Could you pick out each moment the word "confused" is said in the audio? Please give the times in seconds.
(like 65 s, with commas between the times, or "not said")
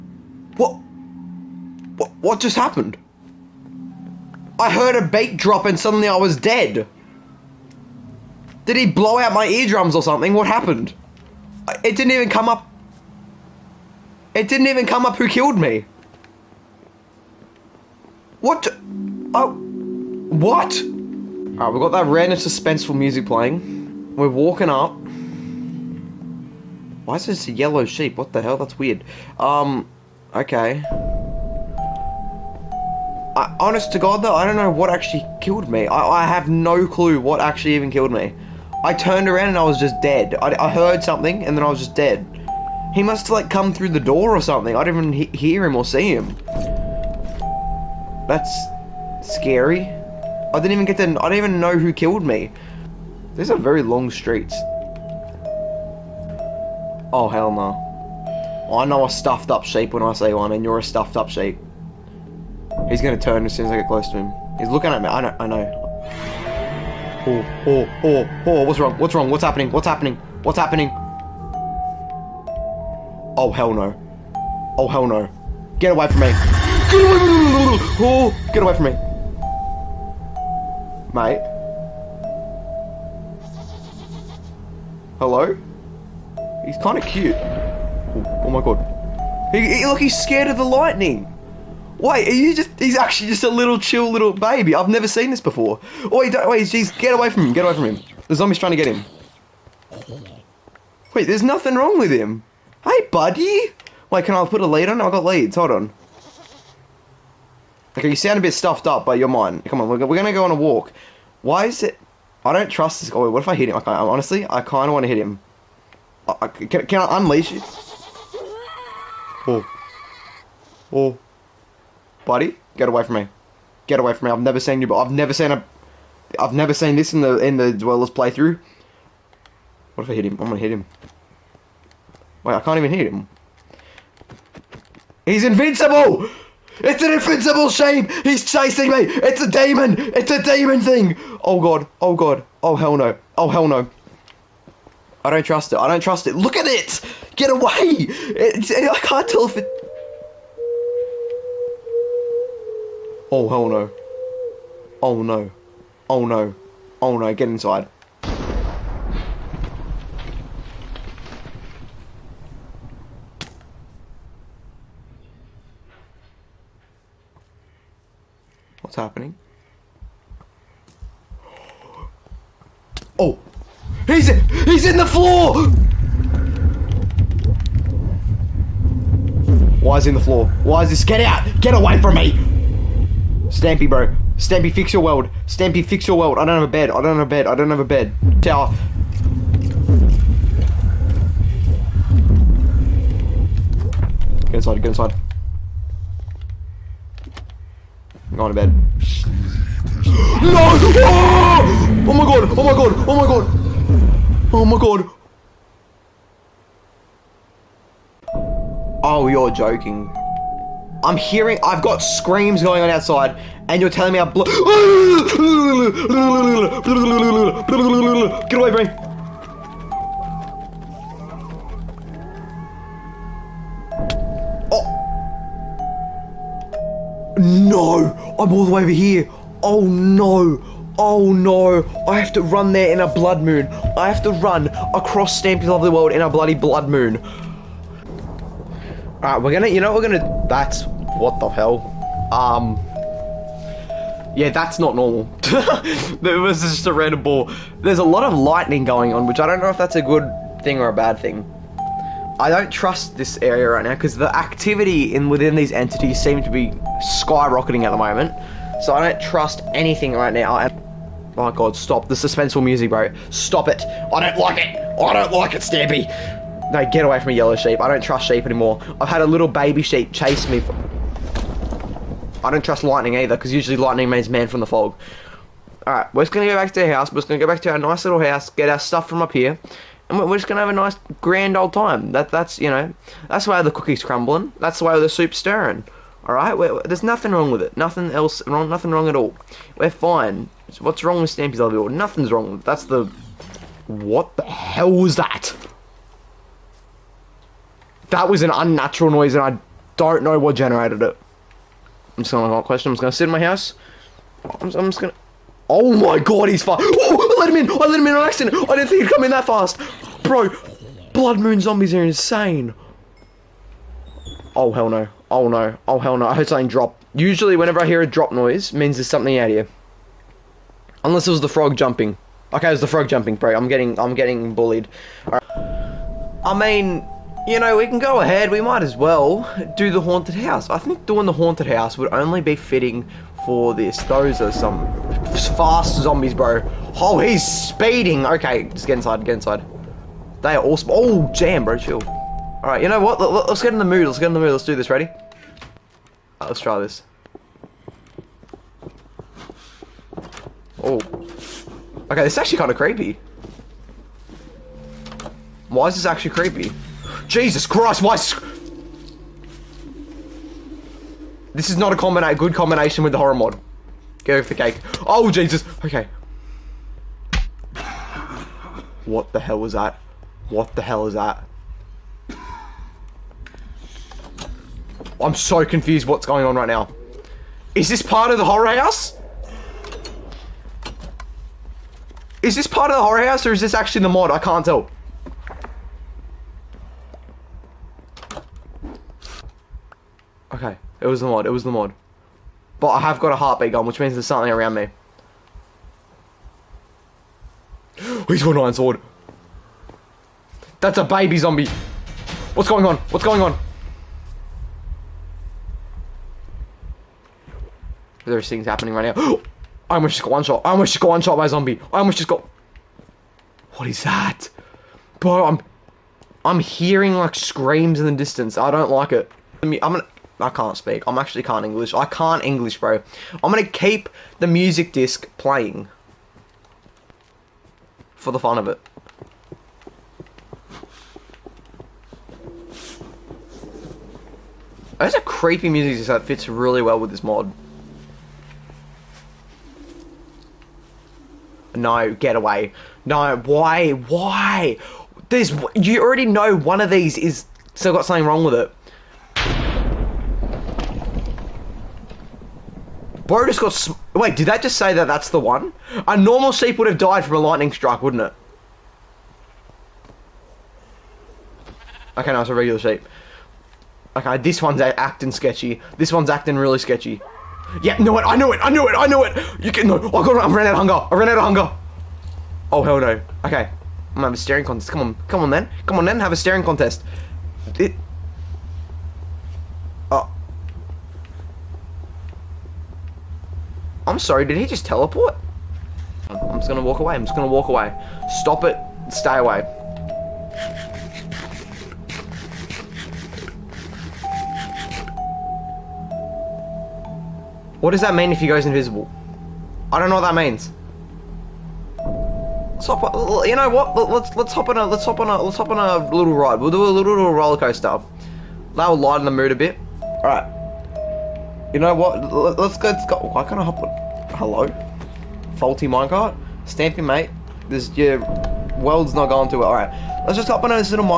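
375 s.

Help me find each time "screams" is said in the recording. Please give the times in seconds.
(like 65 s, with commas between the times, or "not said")
212 s, 417 s.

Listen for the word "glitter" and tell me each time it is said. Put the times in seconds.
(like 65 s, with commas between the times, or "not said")
not said.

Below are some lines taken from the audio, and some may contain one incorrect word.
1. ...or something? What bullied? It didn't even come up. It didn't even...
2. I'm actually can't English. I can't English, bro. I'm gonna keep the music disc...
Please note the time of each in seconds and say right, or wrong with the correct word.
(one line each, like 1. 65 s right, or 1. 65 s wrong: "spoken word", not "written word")
1. 9 s wrong: "happened", not "bullied"
2. 421 s right.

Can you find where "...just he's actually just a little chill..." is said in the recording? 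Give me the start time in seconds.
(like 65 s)
92 s.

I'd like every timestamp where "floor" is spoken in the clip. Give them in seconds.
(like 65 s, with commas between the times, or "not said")
175 s, 180 s.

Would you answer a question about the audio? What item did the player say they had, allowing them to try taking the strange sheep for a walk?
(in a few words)
Leads.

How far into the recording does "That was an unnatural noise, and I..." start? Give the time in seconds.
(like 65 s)
298 s.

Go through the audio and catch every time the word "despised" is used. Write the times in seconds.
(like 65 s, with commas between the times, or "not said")
not said.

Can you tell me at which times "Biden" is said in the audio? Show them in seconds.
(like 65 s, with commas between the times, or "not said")
not said.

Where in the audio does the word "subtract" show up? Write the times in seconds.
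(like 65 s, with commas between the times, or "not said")
not said.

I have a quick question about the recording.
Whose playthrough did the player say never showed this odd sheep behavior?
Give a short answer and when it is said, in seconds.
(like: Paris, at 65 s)
The Dwellers, at 127 s.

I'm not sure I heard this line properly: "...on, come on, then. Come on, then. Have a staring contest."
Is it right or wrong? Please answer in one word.
right.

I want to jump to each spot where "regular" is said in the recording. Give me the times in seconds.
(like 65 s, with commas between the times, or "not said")
462 s.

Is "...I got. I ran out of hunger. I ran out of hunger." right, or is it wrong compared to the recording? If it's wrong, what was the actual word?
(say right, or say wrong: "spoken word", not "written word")
right.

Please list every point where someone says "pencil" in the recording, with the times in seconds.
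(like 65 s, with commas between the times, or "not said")
not said.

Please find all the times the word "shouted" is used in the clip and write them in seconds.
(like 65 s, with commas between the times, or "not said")
not said.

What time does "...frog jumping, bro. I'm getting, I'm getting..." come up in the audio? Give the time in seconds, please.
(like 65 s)
322 s.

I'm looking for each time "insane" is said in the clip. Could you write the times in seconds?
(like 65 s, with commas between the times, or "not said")
312 s.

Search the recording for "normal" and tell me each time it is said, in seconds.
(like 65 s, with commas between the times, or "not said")
244 s, 456 s.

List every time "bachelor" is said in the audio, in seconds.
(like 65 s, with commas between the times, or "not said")
not said.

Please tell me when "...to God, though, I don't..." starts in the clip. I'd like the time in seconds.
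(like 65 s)
33 s.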